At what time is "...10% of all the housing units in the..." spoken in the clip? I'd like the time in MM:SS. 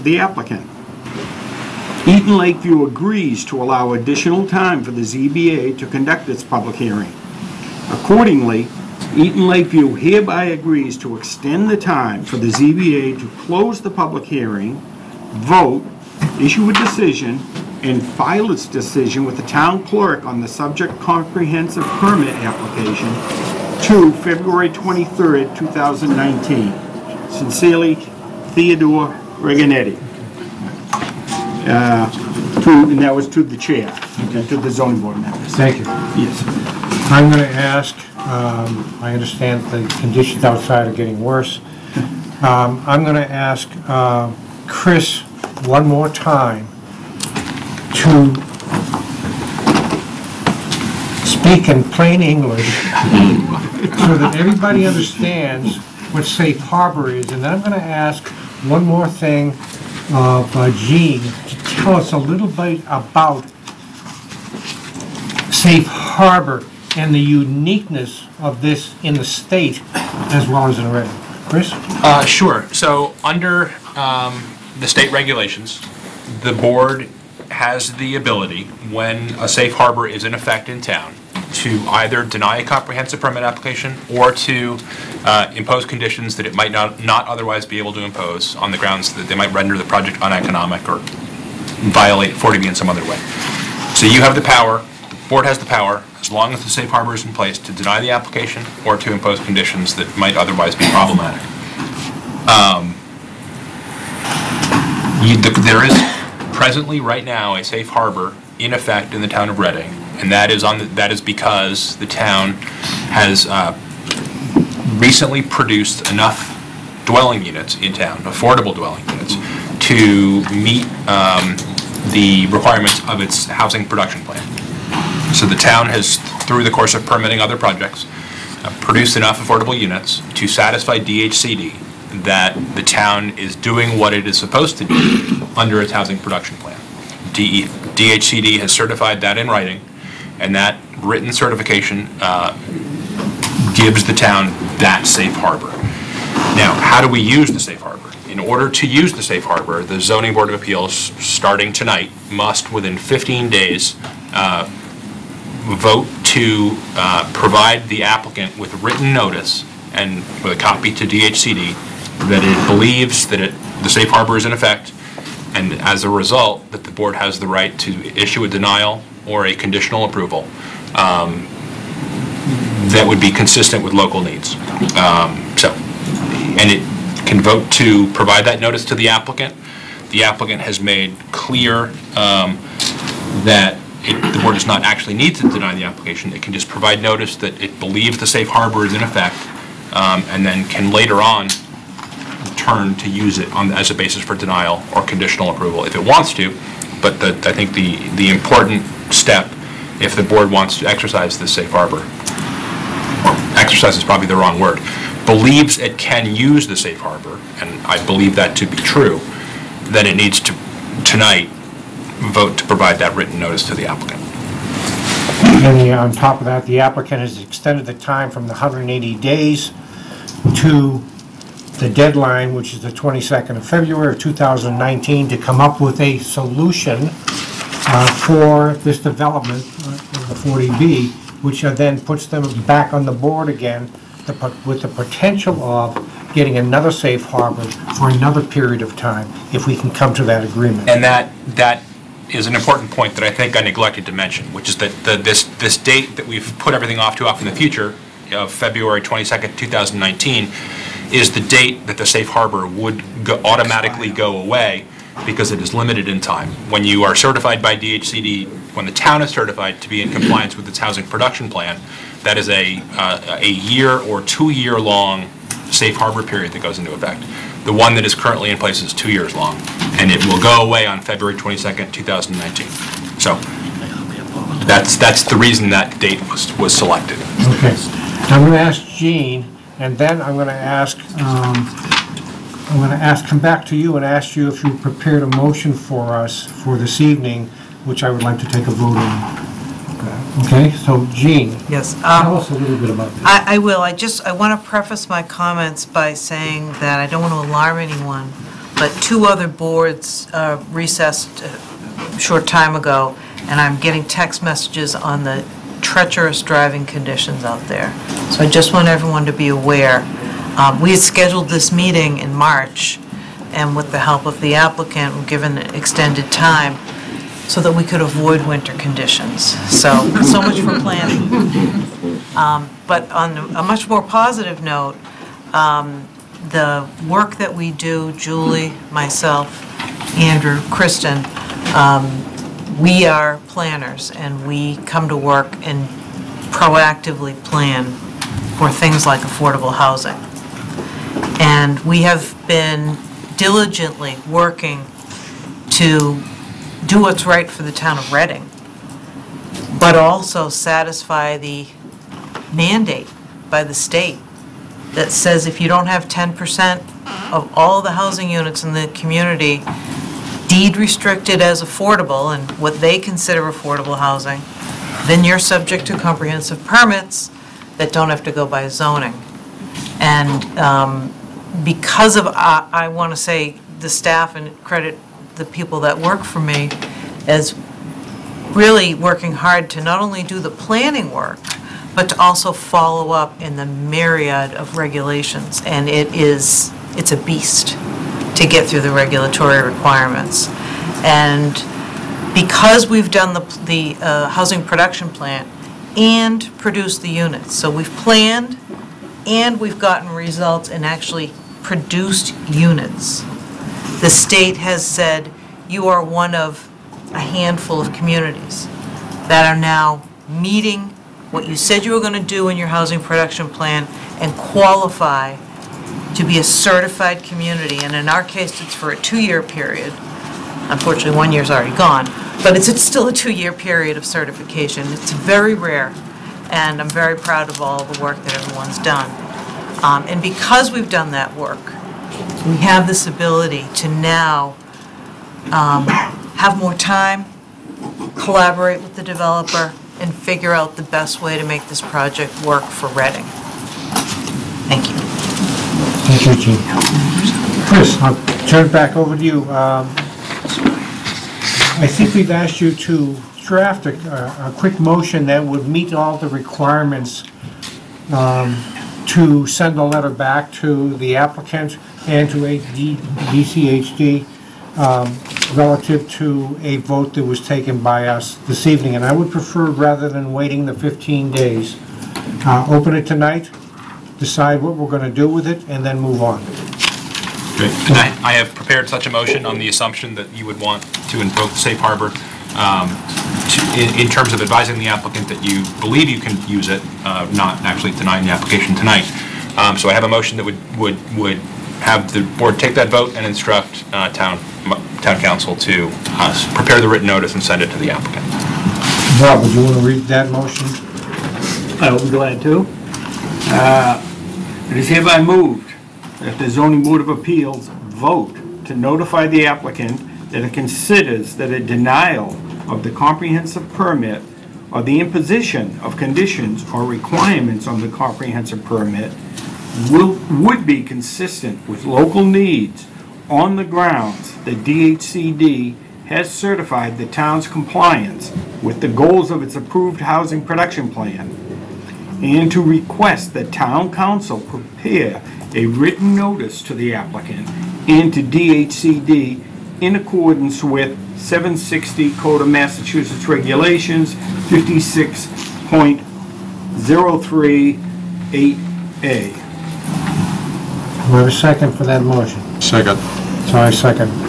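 05:56.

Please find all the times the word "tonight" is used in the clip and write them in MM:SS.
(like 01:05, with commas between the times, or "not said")
02:31, 03:31, 07:53, 08:08.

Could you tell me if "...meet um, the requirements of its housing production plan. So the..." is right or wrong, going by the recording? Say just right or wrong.
right.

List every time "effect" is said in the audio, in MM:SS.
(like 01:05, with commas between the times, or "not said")
01:20, 01:48, 02:44, 03:09, 04:26.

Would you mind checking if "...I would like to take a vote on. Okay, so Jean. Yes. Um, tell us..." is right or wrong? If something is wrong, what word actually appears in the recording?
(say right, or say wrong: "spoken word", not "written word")
right.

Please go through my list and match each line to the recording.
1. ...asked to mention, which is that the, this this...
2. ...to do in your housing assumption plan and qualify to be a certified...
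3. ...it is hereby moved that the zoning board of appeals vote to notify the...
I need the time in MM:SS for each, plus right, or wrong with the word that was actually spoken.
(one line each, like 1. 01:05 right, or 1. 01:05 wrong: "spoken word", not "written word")
1. 04:03 wrong: "neglected", not "asked"
2. 06:52 wrong: "production", not "assumption"
3. 08:24 right.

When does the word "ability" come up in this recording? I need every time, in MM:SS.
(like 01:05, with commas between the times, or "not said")
01:18, 07:13.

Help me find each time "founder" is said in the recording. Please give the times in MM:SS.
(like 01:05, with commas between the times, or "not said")
not said.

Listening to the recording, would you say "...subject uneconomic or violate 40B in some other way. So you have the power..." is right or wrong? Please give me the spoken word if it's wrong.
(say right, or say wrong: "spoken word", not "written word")
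wrong: "project", not "subject".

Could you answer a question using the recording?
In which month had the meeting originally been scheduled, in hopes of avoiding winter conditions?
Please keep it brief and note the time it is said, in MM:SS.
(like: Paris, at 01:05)
March, at 05:12.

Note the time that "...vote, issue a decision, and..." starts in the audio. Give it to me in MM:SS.
00:15.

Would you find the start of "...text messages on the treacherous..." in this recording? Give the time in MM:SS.
05:04.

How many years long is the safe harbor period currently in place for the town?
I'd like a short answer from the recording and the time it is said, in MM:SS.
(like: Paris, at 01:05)
2, at 04:28.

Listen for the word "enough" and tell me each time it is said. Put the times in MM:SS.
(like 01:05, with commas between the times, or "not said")
01:56, 02:09.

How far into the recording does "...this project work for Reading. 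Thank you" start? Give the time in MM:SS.
07:21.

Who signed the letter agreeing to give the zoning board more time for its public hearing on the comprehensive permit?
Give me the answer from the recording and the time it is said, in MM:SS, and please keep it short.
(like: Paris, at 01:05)
Theodore Regnante, at 00:28.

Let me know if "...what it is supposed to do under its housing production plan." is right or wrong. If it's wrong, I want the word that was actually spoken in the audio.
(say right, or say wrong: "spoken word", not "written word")
right.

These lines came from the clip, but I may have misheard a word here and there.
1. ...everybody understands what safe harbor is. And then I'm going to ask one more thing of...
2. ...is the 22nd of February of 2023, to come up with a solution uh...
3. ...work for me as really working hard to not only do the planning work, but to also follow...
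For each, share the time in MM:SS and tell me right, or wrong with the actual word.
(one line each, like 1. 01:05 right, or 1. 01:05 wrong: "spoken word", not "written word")
1. 00:54 right
2. 03:42 wrong: "2019", not "2023"
3. 06:15 right.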